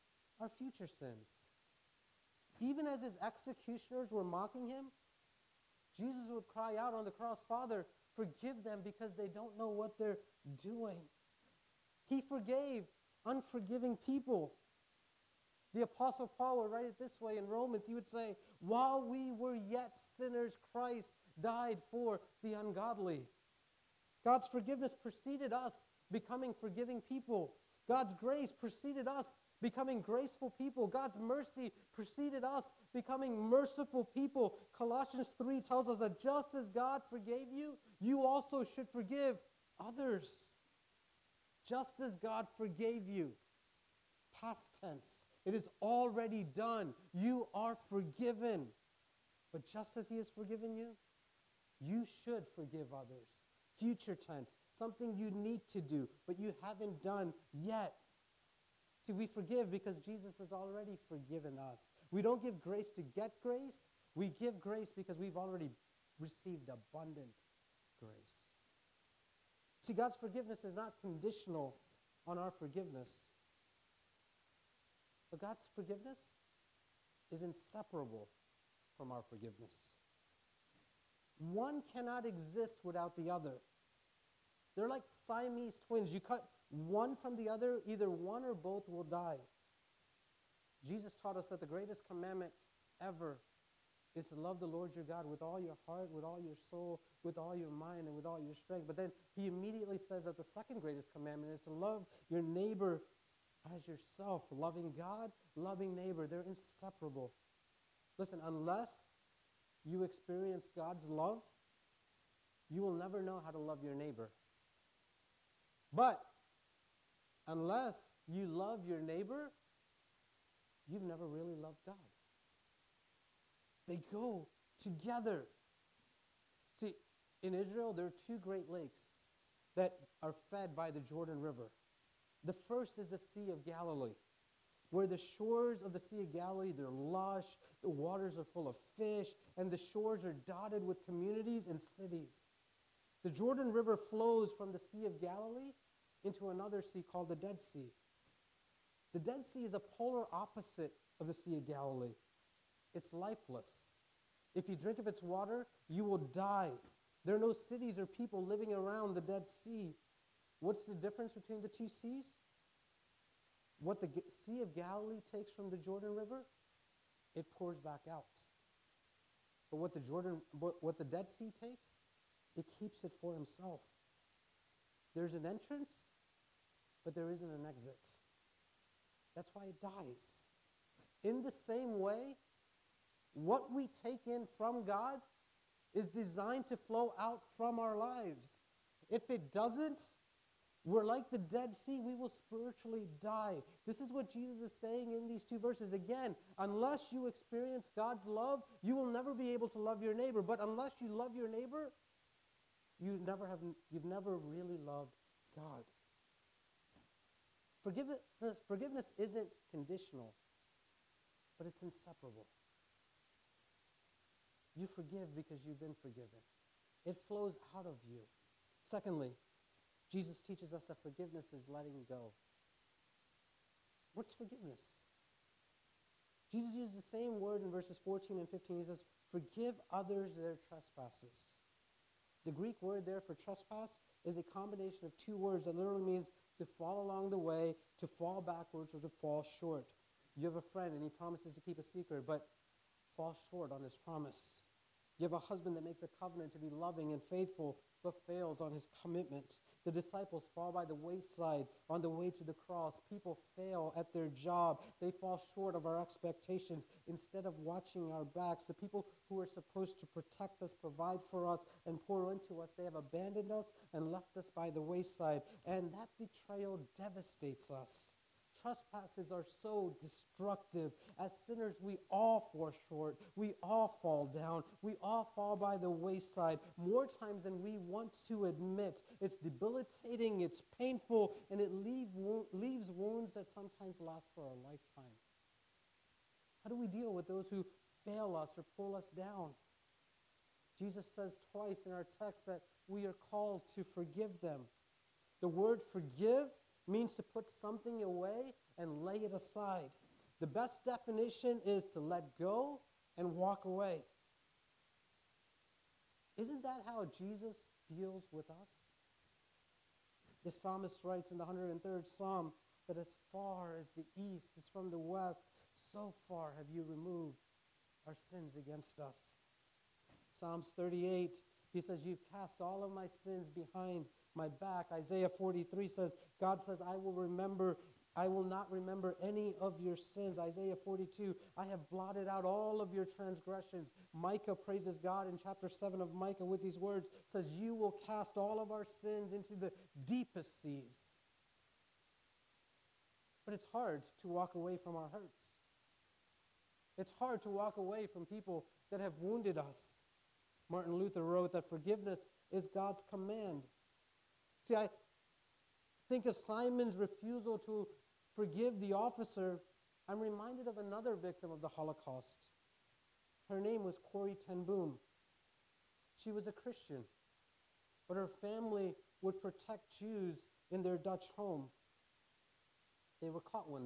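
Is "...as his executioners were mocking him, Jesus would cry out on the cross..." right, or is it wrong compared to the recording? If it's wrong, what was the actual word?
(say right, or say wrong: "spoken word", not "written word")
right.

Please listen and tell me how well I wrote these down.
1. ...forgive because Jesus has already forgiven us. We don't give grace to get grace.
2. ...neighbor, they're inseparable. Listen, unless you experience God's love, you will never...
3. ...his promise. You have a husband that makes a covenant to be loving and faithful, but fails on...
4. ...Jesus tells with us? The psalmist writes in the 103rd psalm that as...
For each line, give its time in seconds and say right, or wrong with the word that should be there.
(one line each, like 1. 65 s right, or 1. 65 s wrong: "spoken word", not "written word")
1. 59 s right
2. 105 s right
3. 243 s right
4. 307 s wrong: "deals", not "tells".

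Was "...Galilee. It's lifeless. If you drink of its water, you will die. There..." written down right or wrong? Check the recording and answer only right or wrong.
right.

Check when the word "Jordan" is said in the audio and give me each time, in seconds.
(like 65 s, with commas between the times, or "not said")
130 s, 143 s, 165 s, 169 s.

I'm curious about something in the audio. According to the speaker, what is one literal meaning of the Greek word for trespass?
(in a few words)
to fall along the way.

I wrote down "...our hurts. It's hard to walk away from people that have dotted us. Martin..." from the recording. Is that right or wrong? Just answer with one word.
wrong.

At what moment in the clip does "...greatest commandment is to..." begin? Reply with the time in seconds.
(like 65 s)
100 s.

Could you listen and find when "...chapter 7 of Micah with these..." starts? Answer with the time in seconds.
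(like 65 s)
335 s.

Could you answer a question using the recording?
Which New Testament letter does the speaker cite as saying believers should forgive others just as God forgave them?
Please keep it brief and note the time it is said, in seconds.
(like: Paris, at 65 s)
Colossians 3, at 34 s.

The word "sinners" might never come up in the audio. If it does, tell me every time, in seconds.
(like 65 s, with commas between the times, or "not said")
20 s, 271 s.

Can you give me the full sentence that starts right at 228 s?
He says, Forgive others their trespasses.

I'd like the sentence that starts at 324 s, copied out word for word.
Isaiah 43 says, God says, I will remember I will not remember any of your sins.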